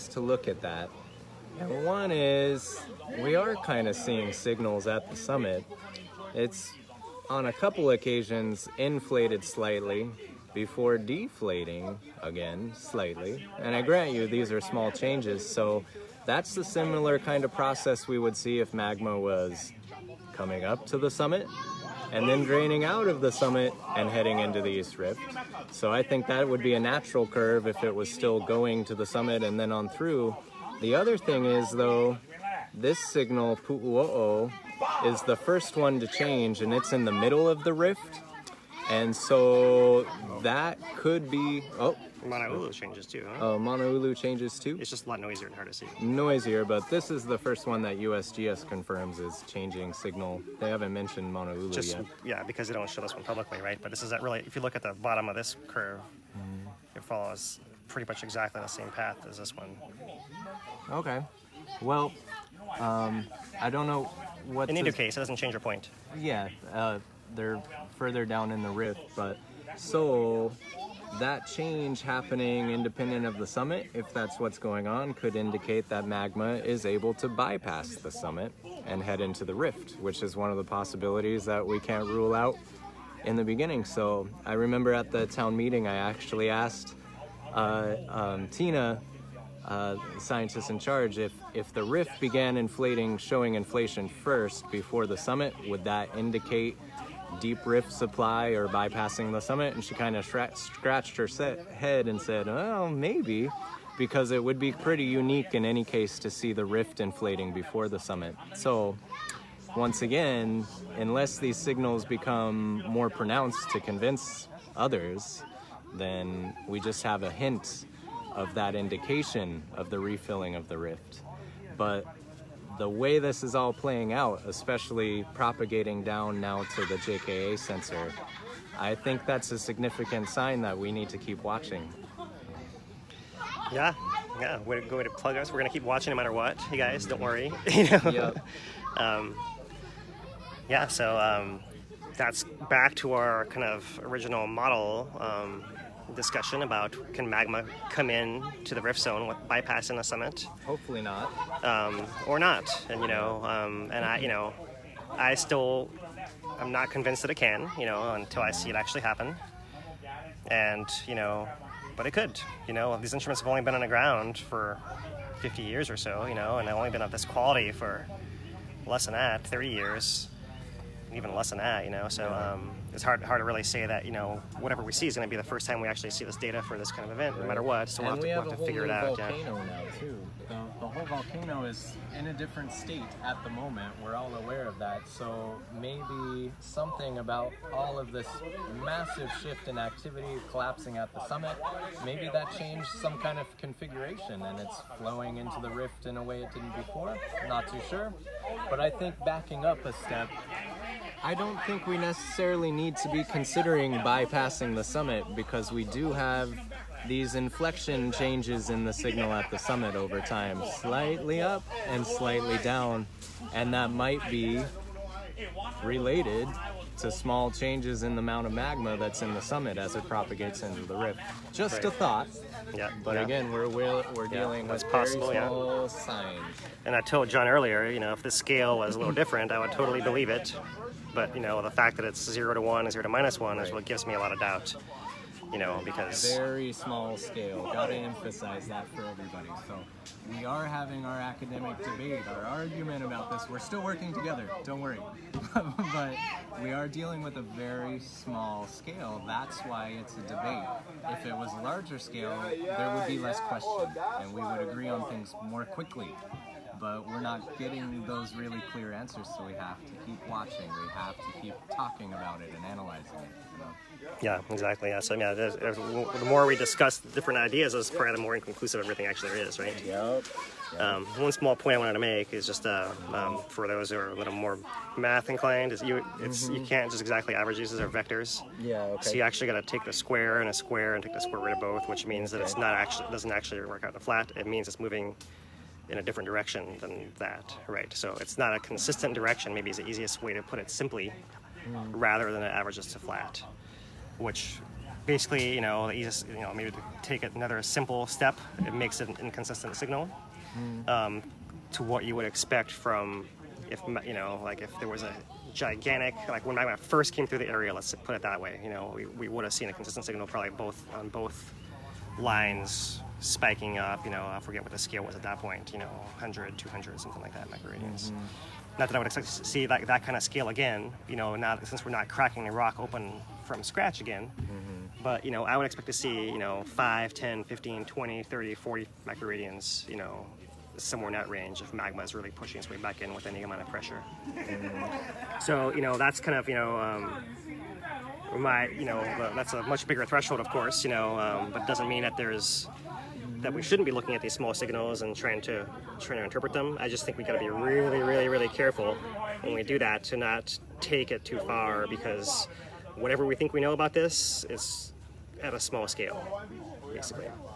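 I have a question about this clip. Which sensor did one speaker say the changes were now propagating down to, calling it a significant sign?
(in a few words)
JKA.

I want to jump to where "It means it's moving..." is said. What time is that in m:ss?
4:44.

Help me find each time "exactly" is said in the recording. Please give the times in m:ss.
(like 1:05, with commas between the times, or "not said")
0:58, 4:24, 4:37.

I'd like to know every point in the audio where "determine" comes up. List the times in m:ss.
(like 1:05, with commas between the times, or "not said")
not said.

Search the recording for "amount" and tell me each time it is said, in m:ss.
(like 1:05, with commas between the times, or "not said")
3:38, 5:33.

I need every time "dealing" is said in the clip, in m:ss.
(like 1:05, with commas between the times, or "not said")
3:44, 4:06.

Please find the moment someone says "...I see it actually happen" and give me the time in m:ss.
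2:38.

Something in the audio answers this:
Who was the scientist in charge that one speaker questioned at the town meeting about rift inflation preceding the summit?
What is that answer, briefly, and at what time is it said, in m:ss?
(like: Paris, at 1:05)
Tina, at 1:28.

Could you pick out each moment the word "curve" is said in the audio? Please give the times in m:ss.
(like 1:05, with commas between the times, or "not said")
0:27, 0:55.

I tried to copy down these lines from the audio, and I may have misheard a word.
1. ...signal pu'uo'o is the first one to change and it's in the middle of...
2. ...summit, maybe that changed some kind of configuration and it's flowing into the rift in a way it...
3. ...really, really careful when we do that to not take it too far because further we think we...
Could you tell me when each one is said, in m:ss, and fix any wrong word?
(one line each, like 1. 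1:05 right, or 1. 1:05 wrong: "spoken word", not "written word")
1. 0:32 right
2. 3:11 right
3. 5:48 wrong: "whatever", not "further".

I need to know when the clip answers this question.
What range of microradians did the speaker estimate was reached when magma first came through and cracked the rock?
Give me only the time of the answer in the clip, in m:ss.
5:15.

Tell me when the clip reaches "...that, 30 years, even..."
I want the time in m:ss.
2:49.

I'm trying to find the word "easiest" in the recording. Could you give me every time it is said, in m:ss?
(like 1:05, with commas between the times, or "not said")
4:49, 4:55.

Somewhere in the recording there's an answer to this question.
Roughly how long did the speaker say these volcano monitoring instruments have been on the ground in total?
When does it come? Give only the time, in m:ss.
2:45.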